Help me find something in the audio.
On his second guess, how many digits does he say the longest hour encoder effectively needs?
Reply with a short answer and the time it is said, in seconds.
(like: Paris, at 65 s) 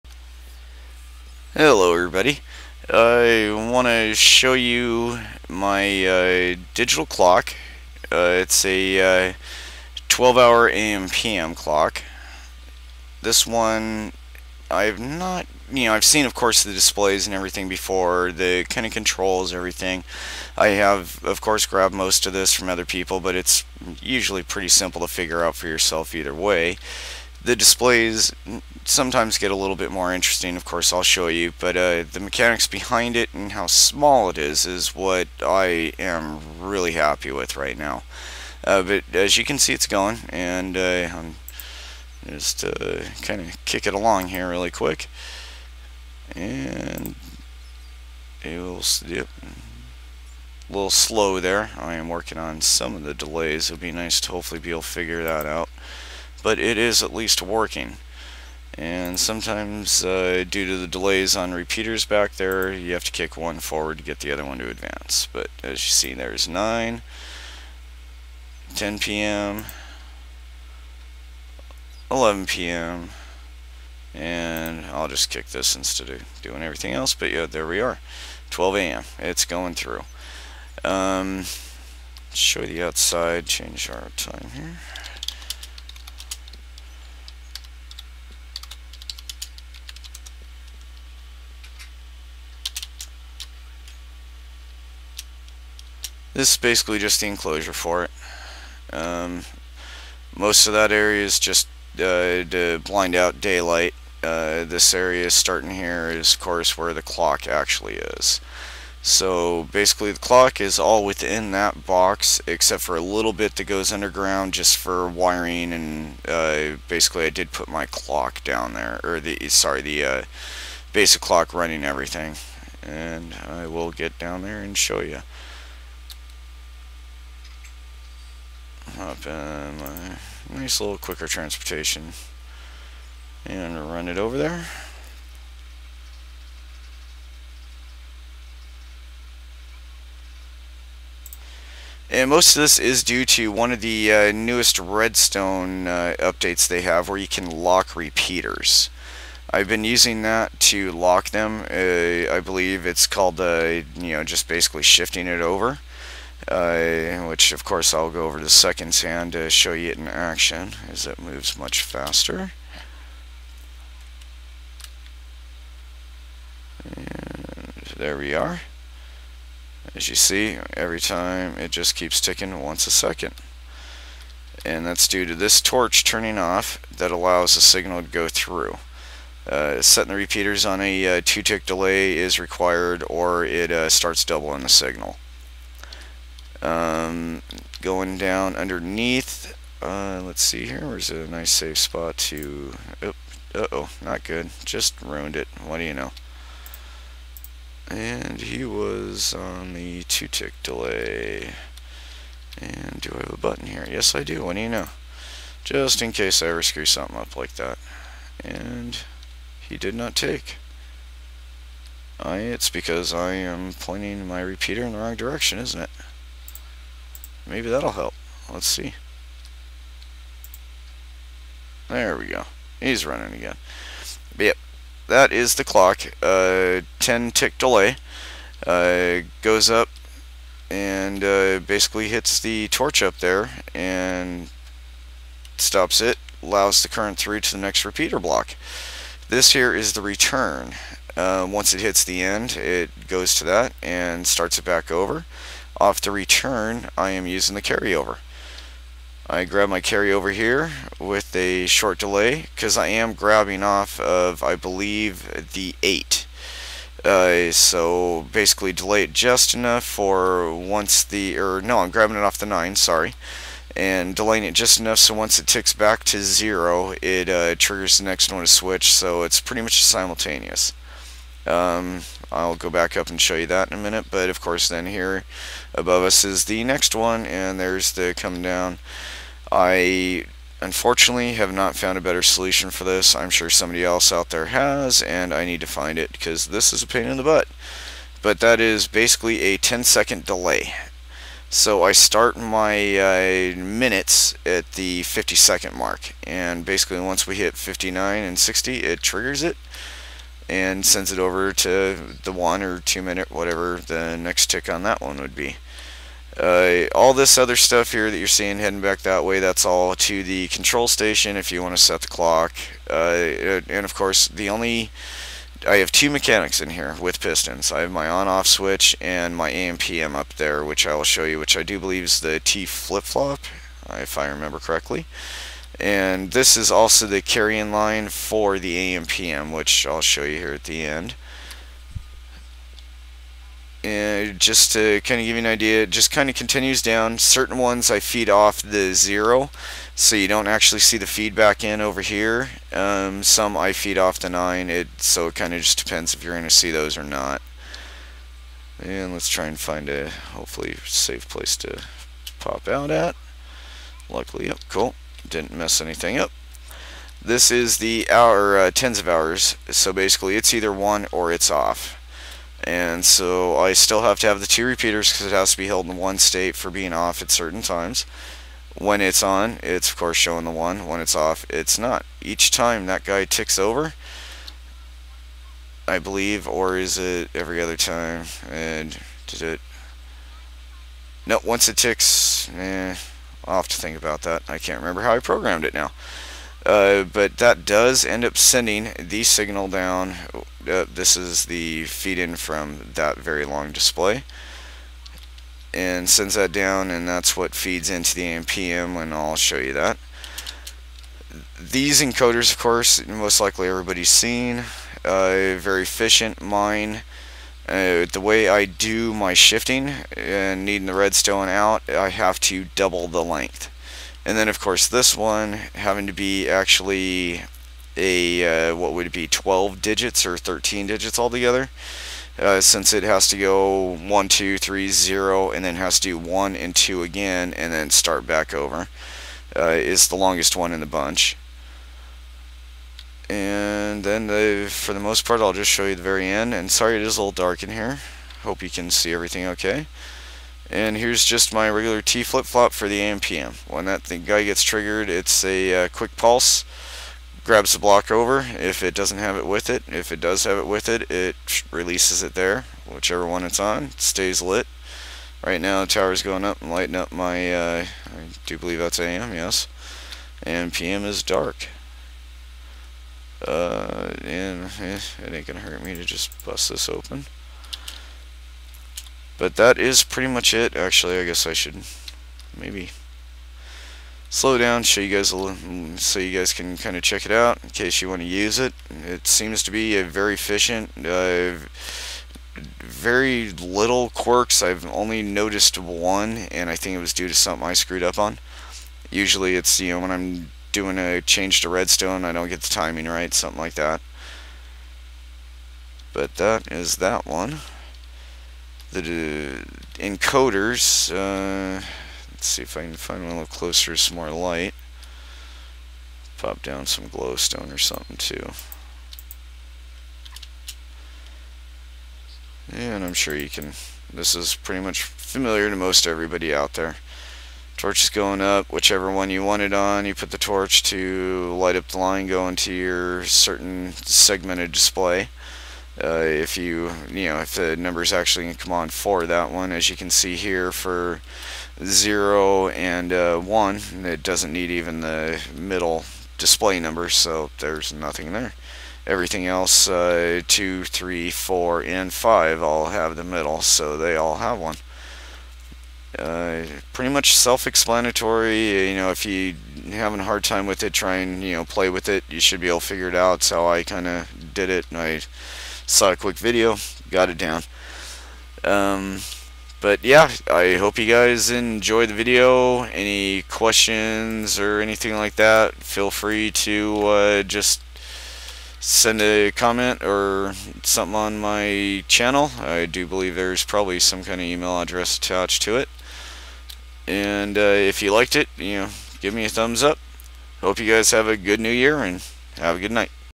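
13, at 420 s.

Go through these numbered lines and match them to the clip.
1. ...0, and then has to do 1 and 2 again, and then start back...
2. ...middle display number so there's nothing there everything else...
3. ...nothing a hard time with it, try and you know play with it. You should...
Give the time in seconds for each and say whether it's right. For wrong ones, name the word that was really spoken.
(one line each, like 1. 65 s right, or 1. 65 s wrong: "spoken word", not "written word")
1. 424 s right
2. 535 s right
3. 549 s wrong: "having", not "nothing".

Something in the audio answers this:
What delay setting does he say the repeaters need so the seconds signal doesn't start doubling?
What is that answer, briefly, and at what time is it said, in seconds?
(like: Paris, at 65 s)
2 tick, at 181 s.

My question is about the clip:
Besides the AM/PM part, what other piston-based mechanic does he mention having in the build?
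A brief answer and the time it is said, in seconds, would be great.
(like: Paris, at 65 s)
on-off switch, at 318 s.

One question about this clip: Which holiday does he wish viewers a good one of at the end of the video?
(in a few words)
new year.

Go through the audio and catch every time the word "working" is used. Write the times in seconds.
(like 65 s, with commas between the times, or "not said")
52 s, 57 s.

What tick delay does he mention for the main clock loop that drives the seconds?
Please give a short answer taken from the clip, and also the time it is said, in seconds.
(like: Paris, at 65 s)
10 tick, at 226 s.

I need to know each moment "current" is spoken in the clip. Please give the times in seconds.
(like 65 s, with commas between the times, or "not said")
236 s.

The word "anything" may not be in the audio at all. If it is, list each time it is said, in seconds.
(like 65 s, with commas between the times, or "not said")
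355 s, 564 s.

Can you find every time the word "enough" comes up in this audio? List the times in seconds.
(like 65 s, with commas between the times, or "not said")
259 s, 264 s.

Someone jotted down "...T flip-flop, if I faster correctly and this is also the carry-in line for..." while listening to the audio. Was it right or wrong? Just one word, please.
wrong.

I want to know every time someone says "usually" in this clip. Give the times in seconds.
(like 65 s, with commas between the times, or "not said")
24 s, 489 s.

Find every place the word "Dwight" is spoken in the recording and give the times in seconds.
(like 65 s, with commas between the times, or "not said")
not said.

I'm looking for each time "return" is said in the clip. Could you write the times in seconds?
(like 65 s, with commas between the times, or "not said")
240 s, 246 s.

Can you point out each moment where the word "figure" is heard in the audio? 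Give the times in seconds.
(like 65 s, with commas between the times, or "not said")
25 s, 54 s, 552 s.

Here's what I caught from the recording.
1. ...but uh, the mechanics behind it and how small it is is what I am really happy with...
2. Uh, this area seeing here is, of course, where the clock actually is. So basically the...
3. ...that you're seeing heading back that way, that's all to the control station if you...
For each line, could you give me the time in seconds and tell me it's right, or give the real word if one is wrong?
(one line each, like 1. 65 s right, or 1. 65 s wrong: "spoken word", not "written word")
1. 31 s right
2. 104 s wrong: "starting", not "seeing"
3. 308 s right.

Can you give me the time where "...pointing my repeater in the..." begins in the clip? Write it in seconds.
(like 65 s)
213 s.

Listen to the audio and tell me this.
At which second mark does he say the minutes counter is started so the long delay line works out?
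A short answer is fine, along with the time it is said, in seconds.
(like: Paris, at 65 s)
50, at 295 s.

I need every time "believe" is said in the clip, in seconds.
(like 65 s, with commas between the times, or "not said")
152 s, 254 s, 321 s, 375 s, 458 s, 573 s.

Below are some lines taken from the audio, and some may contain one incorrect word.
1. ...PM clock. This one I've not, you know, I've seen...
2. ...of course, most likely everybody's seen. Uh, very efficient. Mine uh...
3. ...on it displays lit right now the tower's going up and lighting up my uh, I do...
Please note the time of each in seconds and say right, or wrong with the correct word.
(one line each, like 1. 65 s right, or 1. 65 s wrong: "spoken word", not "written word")
1. 11 s right
2. 402 s right
3. 453 s wrong: "stays", not "displays".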